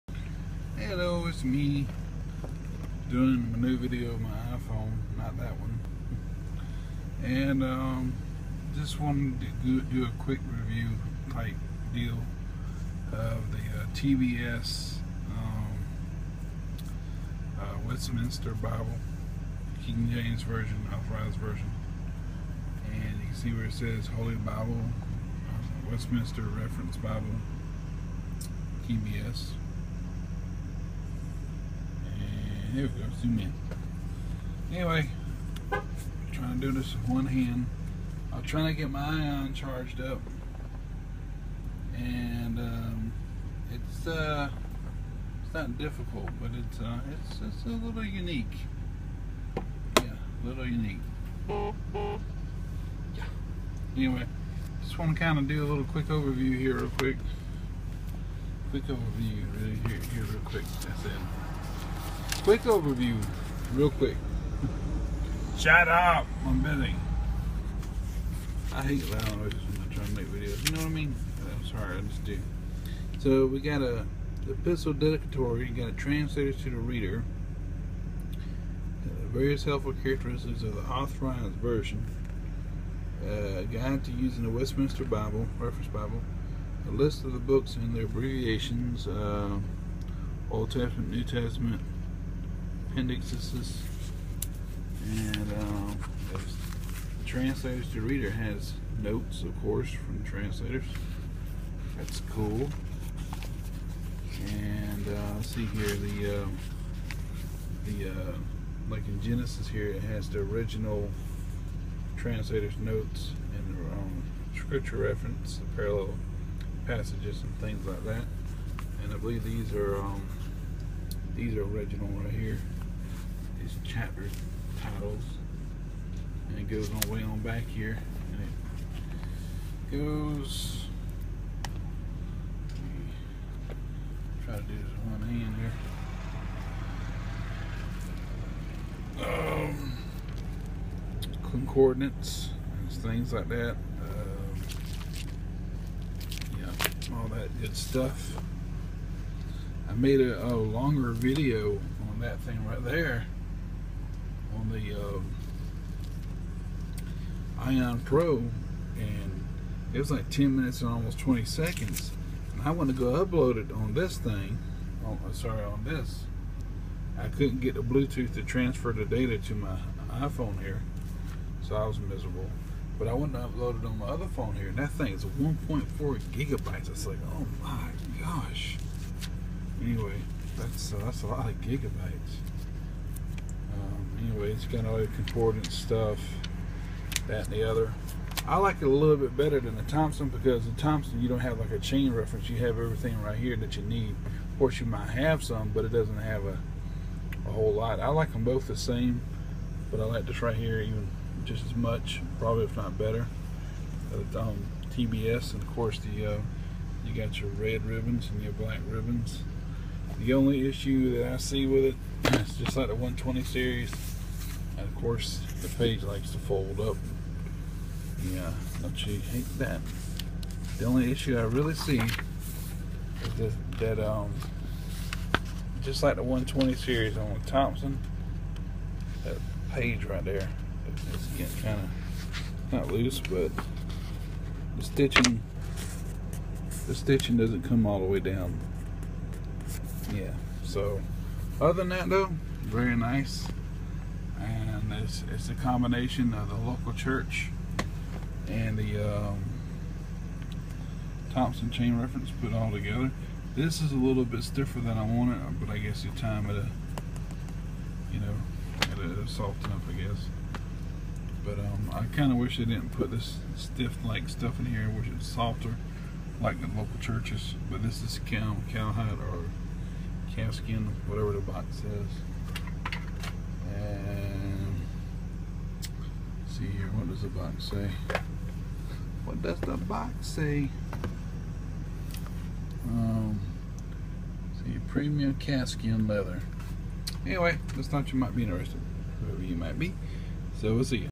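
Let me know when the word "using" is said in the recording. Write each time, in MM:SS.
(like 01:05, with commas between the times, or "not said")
01:24.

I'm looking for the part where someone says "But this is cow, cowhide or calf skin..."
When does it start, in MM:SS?
04:27.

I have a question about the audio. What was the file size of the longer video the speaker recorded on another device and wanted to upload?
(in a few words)
1.4 gigabytes.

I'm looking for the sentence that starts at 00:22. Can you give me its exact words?
And you can see where it says Holy Bible, uh, Westminster Reference Bible, TBS.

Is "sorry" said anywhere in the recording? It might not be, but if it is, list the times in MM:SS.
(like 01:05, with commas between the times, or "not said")
01:11, 02:45.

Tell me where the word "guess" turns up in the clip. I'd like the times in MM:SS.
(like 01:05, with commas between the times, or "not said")
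04:15, 04:19.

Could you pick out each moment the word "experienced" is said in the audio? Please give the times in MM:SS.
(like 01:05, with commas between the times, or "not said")
not said.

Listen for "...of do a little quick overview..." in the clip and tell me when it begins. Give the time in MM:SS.
00:55.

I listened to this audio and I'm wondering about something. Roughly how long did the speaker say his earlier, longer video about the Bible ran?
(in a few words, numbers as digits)
10 minutes and almost 20 seconds.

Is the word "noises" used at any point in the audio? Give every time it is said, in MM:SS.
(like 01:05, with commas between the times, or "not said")
01:09.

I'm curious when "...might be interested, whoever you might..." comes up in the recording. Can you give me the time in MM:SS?
04:48.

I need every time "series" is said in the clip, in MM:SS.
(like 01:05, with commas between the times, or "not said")
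03:33, 03:46.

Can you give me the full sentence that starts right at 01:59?
And I believe these are um, these are original right here these chapter titles.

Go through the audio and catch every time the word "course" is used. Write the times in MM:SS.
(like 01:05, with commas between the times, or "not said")
01:39, 03:14, 03:25, 03:35.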